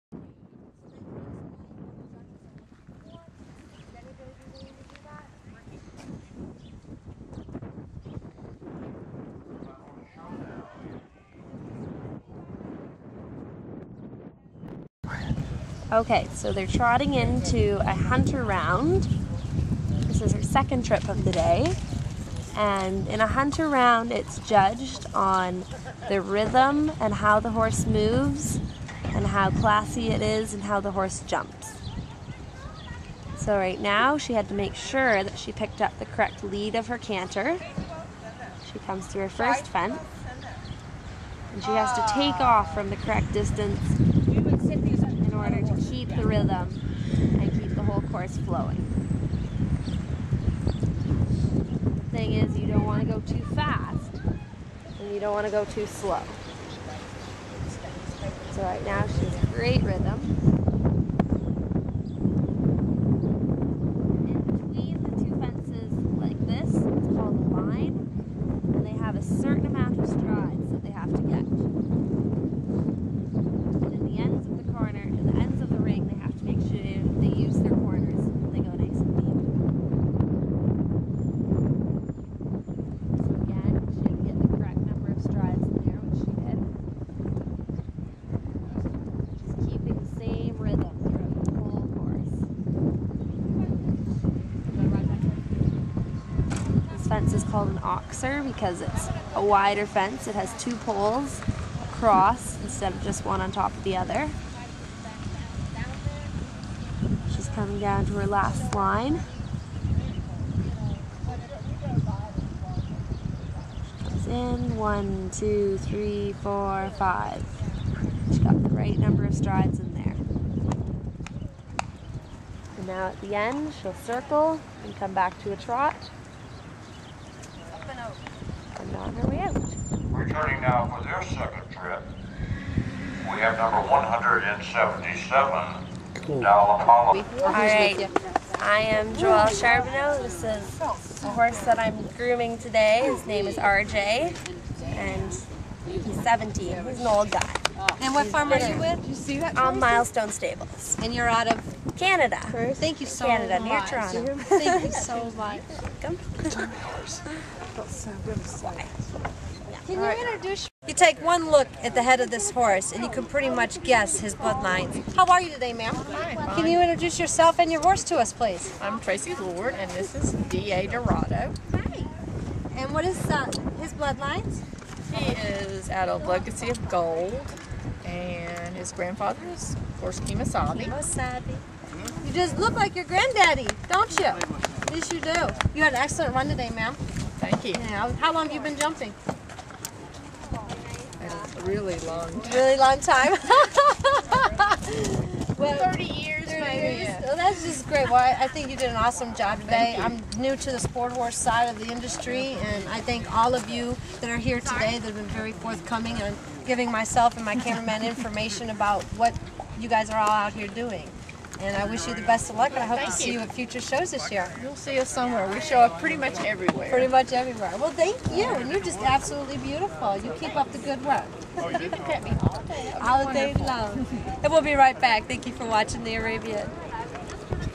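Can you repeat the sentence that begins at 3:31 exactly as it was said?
And I wish you the best of luck, and I hope thank to see you.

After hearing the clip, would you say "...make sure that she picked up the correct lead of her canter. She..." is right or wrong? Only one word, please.
right.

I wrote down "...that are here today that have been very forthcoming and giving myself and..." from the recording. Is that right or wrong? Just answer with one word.
right.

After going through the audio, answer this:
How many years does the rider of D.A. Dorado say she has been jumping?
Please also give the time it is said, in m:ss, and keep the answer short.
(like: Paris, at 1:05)
30, at 3:15.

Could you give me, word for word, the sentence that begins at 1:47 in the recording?
She's coming down to her last line.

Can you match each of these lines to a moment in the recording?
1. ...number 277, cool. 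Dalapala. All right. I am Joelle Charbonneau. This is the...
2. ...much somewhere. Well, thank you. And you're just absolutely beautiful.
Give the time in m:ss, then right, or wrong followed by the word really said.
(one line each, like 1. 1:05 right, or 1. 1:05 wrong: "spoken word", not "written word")
1. 2:13 wrong: "177", not "277"
2. 3:37 wrong: "everywhere", not "somewhere".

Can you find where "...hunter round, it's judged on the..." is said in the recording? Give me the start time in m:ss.
0:23.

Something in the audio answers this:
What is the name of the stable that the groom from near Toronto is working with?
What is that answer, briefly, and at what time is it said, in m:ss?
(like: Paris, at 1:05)
Milestone Stables, at 2:29.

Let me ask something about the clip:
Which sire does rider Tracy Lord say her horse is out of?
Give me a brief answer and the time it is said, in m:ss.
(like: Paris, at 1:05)
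Legacy of Gold, at 2:56.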